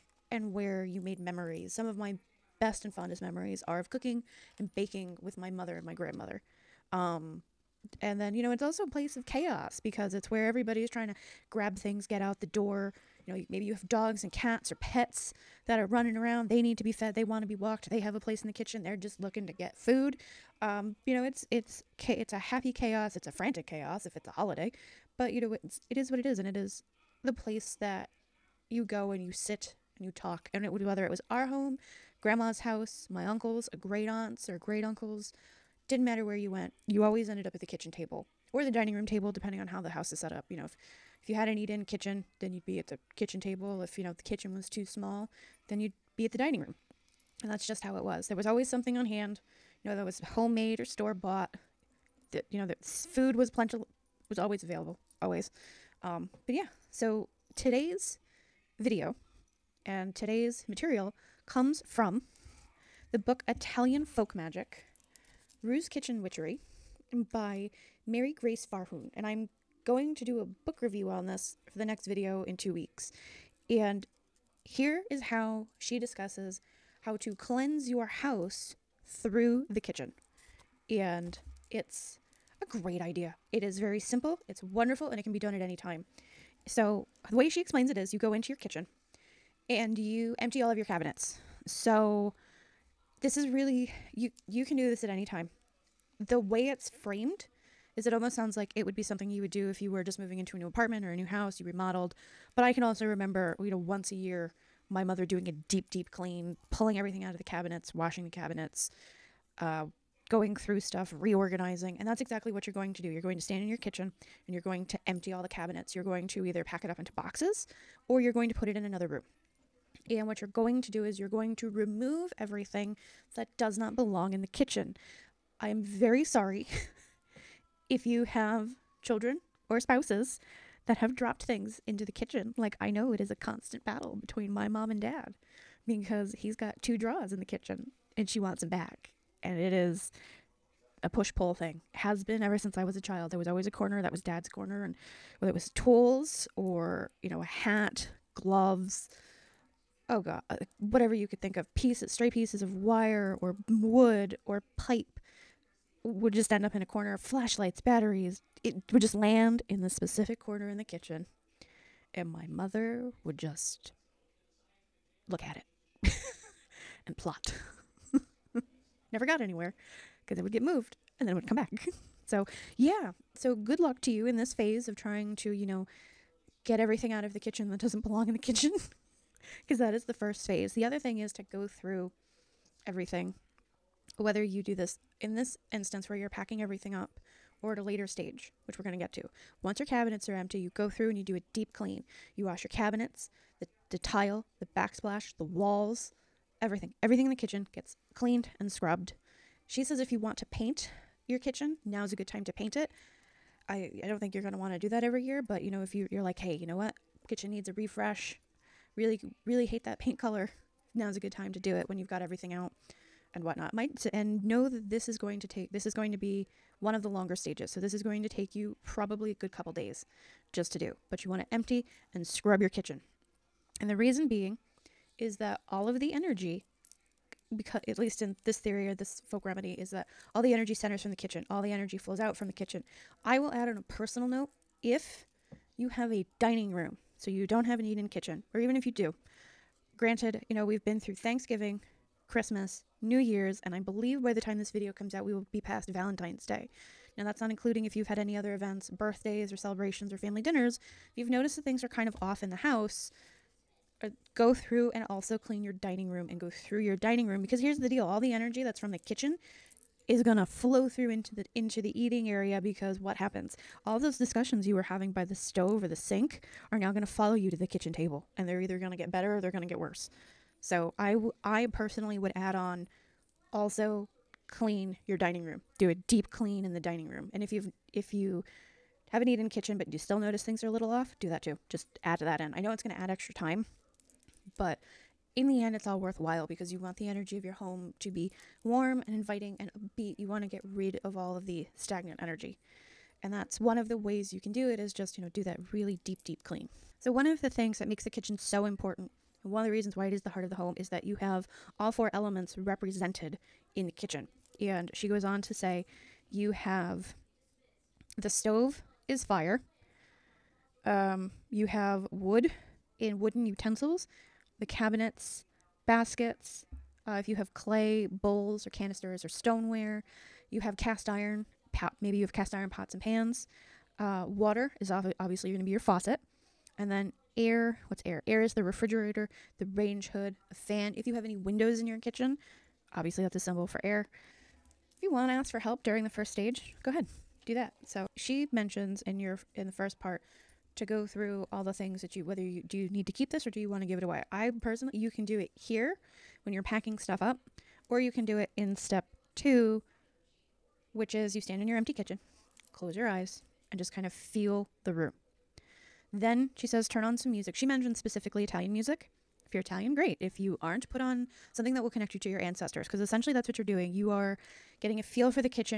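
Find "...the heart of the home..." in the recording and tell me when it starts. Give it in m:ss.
5:00.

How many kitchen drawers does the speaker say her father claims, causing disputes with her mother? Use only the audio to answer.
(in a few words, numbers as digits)
2.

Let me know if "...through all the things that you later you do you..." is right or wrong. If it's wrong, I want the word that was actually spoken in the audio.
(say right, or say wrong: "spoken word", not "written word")
wrong: "whether", not "later".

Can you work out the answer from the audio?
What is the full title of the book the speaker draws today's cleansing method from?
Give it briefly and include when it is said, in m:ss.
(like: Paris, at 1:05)
Italian Folk Magic, at 1:03.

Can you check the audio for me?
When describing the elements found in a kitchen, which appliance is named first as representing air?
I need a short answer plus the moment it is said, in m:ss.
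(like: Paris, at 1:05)
Refrigerator, at 5:28.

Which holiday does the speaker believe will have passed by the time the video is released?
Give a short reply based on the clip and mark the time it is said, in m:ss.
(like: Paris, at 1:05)
Valentine's Day, at 4:05.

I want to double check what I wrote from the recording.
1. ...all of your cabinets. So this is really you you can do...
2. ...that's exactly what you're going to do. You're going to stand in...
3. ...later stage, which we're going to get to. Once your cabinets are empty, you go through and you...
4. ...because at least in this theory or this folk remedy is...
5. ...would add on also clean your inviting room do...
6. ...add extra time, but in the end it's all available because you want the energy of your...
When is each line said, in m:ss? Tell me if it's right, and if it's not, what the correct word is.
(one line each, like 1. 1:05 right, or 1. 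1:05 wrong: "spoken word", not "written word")
1. 1:30 right
2. 1:52 right
3. 3:07 right
4. 3:47 right
5. 4:32 wrong: "dining", not "inviting"
6. 4:42 wrong: "worthwhile", not "available".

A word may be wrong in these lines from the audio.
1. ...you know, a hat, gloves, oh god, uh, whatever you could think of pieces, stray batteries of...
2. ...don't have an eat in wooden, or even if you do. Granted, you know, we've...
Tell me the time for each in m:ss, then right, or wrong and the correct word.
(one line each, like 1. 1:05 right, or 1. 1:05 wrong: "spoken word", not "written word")
1. 2:27 wrong: "pieces", not "batteries"
2. 3:57 wrong: "kitchen", not "wooden".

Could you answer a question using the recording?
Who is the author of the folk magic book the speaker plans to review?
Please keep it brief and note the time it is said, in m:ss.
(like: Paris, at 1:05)
Mary Grace Fahrun, at 1:08.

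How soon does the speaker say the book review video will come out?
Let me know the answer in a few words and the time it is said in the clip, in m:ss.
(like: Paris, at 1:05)
In two weeks, at 1:12.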